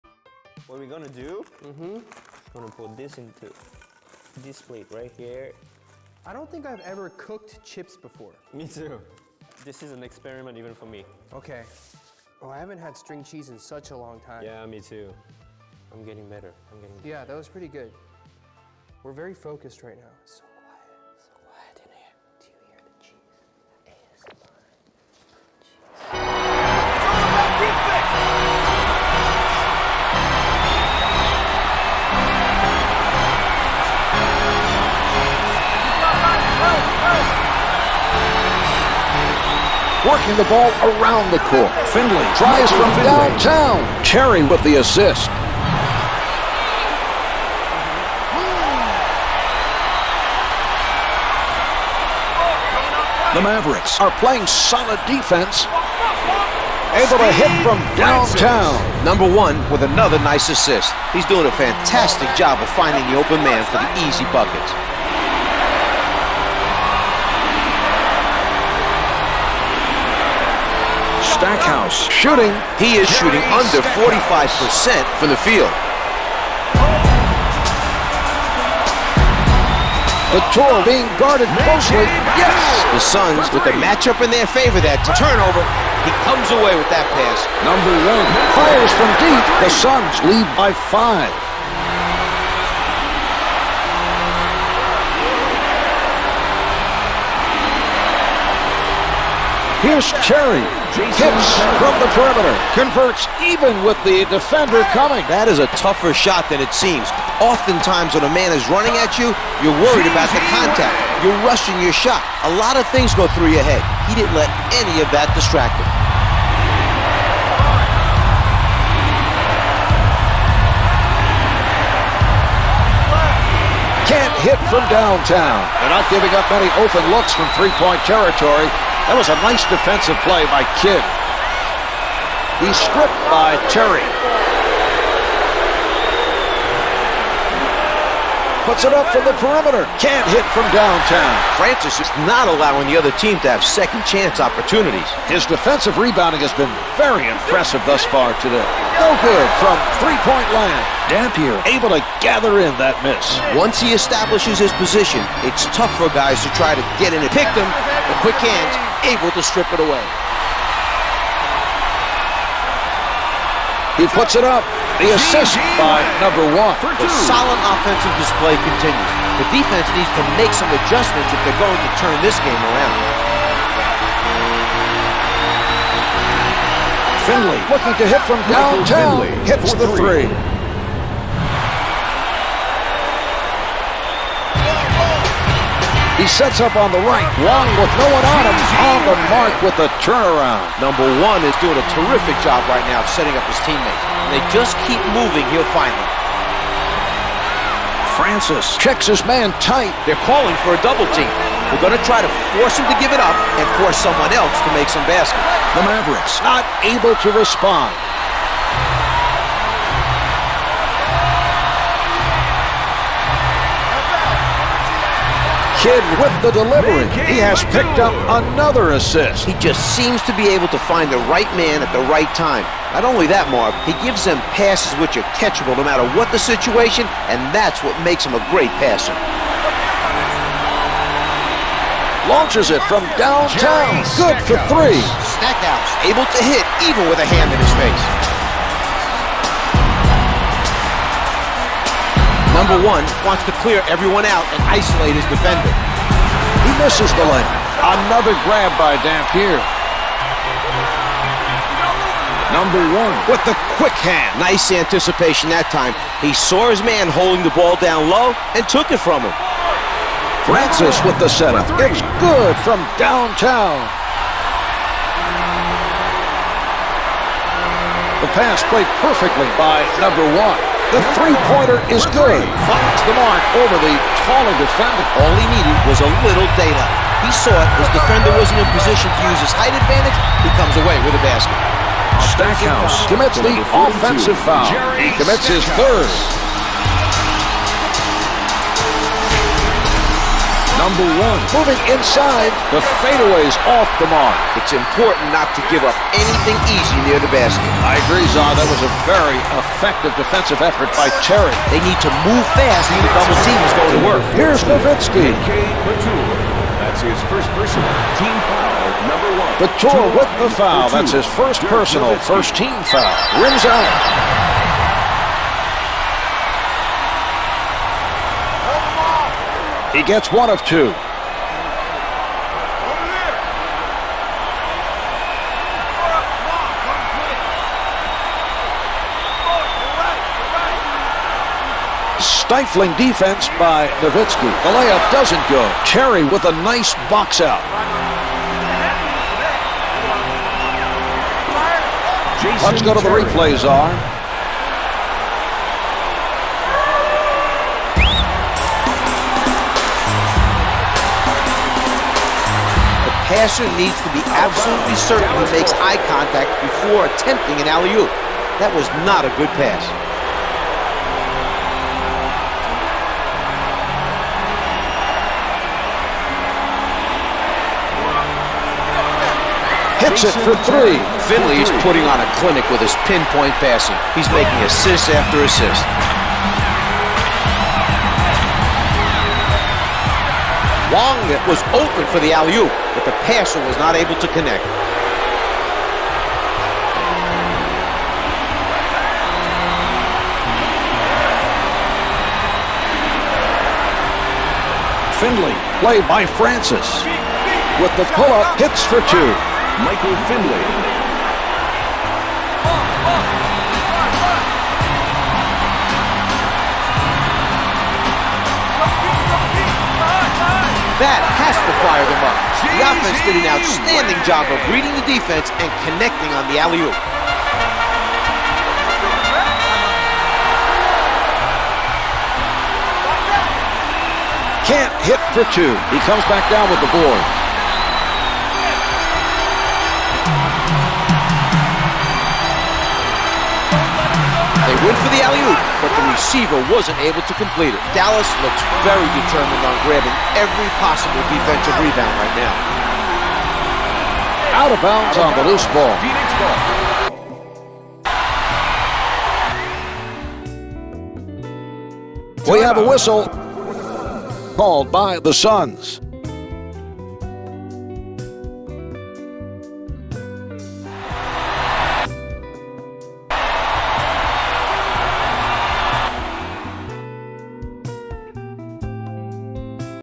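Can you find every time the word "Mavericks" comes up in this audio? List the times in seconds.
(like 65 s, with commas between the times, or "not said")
53 s, 205 s.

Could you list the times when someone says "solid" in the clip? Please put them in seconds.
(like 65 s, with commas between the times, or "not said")
54 s, 167 s.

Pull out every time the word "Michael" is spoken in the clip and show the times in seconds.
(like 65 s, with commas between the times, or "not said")
399 s.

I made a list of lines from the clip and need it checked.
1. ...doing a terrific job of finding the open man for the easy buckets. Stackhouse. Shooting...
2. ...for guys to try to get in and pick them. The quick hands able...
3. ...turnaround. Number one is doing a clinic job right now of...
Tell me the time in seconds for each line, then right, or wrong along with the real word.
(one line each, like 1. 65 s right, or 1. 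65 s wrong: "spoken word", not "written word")
1. 61 s wrong: "fantastic", not "terrific"
2. 155 s right
3. 190 s wrong: "terrific", not "clinic".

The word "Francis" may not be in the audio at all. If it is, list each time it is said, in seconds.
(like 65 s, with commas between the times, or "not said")
141 s, 198 s, 260 s, 396 s.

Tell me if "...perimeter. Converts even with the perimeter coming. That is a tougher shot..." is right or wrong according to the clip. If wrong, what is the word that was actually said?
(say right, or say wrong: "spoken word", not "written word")
wrong: "defender", not "perimeter".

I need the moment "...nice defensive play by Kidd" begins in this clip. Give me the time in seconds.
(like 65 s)
129 s.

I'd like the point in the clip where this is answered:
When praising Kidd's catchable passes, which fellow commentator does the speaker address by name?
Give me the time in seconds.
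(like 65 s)
223 s.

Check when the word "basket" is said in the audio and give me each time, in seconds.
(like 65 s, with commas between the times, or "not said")
205 s, 281 s, 297 s.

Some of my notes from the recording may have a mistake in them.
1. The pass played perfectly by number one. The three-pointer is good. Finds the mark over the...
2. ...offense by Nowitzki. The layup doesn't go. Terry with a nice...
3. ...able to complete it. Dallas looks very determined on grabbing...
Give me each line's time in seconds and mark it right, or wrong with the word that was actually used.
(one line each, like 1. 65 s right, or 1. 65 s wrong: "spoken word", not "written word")
1. 268 s right
2. 332 s wrong: "defense", not "offense"
3. 437 s right.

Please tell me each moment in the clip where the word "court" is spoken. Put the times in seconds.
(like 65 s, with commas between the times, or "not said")
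41 s.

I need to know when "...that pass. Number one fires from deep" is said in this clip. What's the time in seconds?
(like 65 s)
86 s.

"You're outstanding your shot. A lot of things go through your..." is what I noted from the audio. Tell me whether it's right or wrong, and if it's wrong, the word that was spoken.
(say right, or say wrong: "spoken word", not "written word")
wrong: "rushing", not "outstanding".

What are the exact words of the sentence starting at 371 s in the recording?
Finley is putting on a clinic with his pinpoint passing.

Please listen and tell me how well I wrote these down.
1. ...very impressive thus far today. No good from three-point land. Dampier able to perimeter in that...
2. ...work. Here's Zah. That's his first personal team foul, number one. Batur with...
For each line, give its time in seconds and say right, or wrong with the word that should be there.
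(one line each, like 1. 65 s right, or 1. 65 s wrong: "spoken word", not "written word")
1. 146 s wrong: "gather", not "perimeter"
2. 304 s wrong: "Nowitzki", not "Zah".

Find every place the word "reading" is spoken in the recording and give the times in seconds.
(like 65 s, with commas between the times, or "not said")
414 s.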